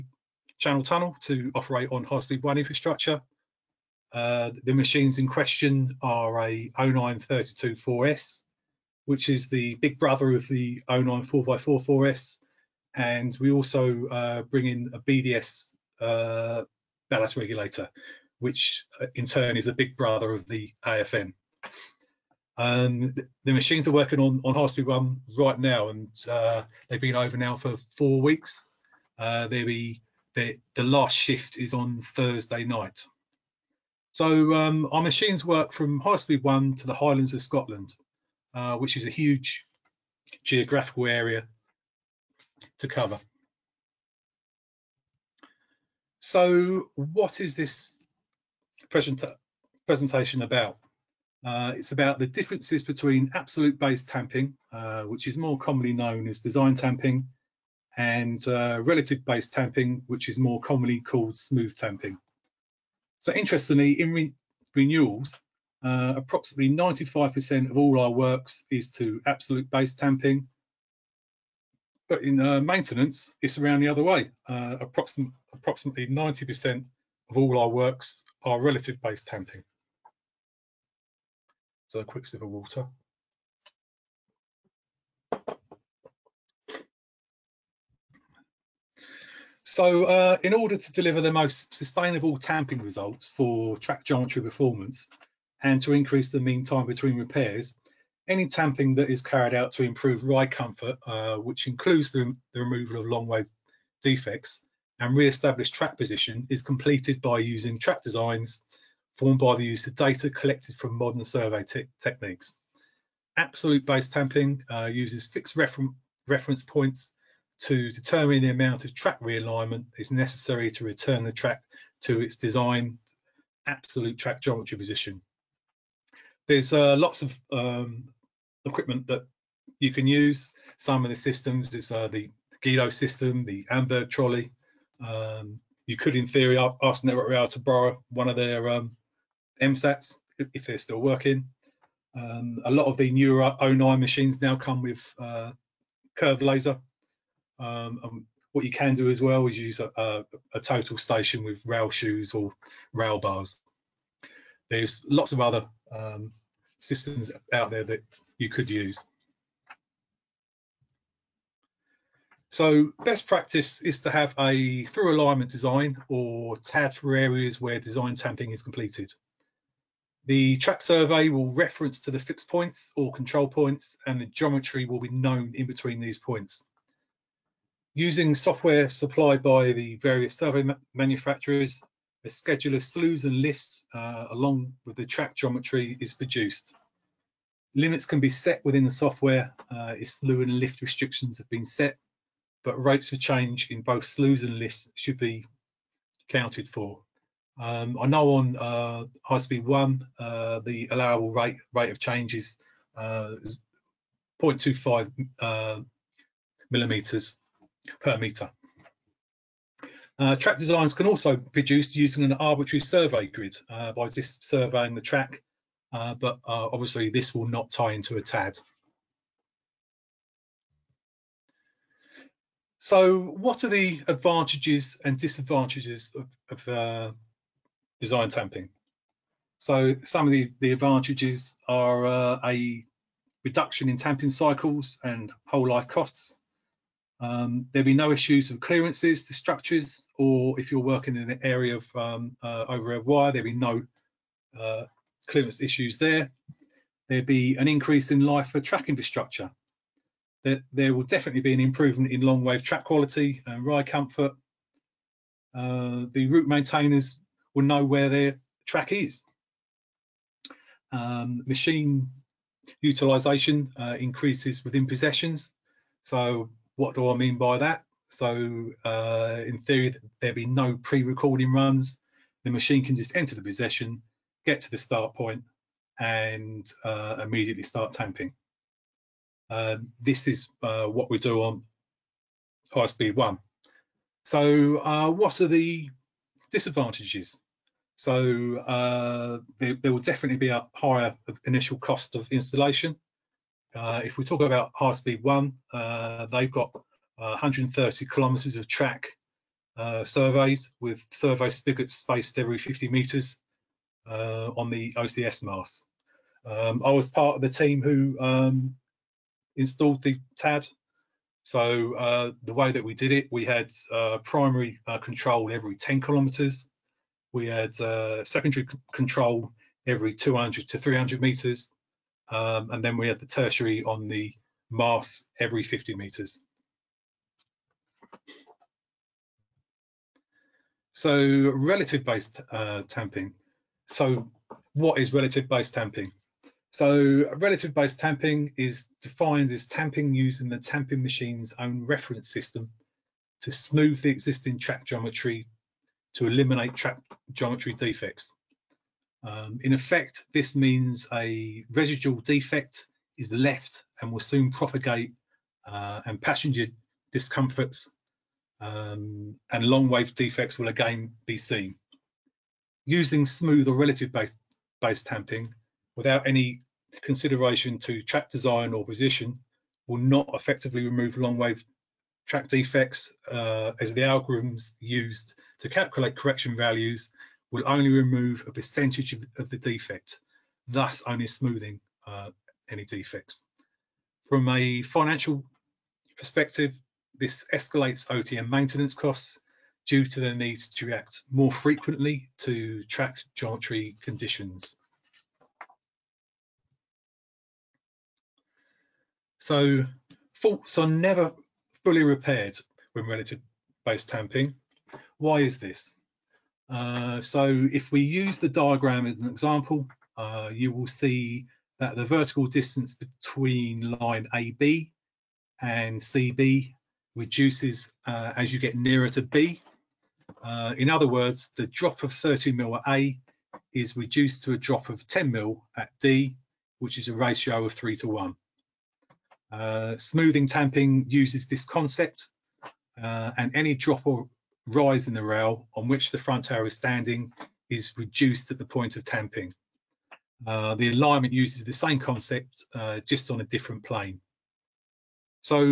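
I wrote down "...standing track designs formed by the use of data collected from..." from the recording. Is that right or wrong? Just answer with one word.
wrong.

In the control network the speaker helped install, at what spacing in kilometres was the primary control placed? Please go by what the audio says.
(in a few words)
10 kilometres.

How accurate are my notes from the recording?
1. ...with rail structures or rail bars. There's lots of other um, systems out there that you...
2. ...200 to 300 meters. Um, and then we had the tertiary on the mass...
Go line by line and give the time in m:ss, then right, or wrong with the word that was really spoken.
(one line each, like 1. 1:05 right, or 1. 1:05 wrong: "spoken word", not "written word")
1. 2:31 wrong: "shoes", not "structures"
2. 5:20 right.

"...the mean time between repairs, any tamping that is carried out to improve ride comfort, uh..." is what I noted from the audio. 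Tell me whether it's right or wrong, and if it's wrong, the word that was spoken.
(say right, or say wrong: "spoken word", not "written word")
right.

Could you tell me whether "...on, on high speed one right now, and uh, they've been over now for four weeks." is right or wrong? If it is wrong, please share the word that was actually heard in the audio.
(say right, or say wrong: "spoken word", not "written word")
right.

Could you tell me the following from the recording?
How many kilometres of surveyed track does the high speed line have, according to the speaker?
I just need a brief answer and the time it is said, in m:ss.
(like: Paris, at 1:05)
130, at 4:57.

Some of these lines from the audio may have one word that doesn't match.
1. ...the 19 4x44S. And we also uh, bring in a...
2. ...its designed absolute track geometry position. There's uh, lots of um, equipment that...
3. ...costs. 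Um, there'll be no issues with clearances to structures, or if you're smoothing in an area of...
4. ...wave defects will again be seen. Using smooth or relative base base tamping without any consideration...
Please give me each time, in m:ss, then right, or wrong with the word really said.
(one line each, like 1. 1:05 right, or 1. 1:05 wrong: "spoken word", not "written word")
1. 0:10 wrong: "09", not "19"
2. 2:02 right
3. 3:55 wrong: "working", not "smoothing"
4. 5:59 right.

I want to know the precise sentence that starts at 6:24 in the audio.
From a financial perspective, this escalates OTM maintenance costs due to the need to react more frequently to track geometry conditions.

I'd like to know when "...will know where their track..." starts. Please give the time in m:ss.
4:17.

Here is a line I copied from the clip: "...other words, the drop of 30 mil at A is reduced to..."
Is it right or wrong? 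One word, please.
right.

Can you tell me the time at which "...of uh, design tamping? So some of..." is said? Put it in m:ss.
3:46.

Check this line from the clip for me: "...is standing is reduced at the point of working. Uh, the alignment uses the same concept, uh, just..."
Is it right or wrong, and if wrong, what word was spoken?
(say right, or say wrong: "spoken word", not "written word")
wrong: "tamping", not "working".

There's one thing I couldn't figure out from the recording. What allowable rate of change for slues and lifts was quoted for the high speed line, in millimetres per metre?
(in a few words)
0.25.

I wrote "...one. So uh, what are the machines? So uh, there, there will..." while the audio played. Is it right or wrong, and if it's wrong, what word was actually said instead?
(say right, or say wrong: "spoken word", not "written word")
wrong: "disadvantages", not "machines".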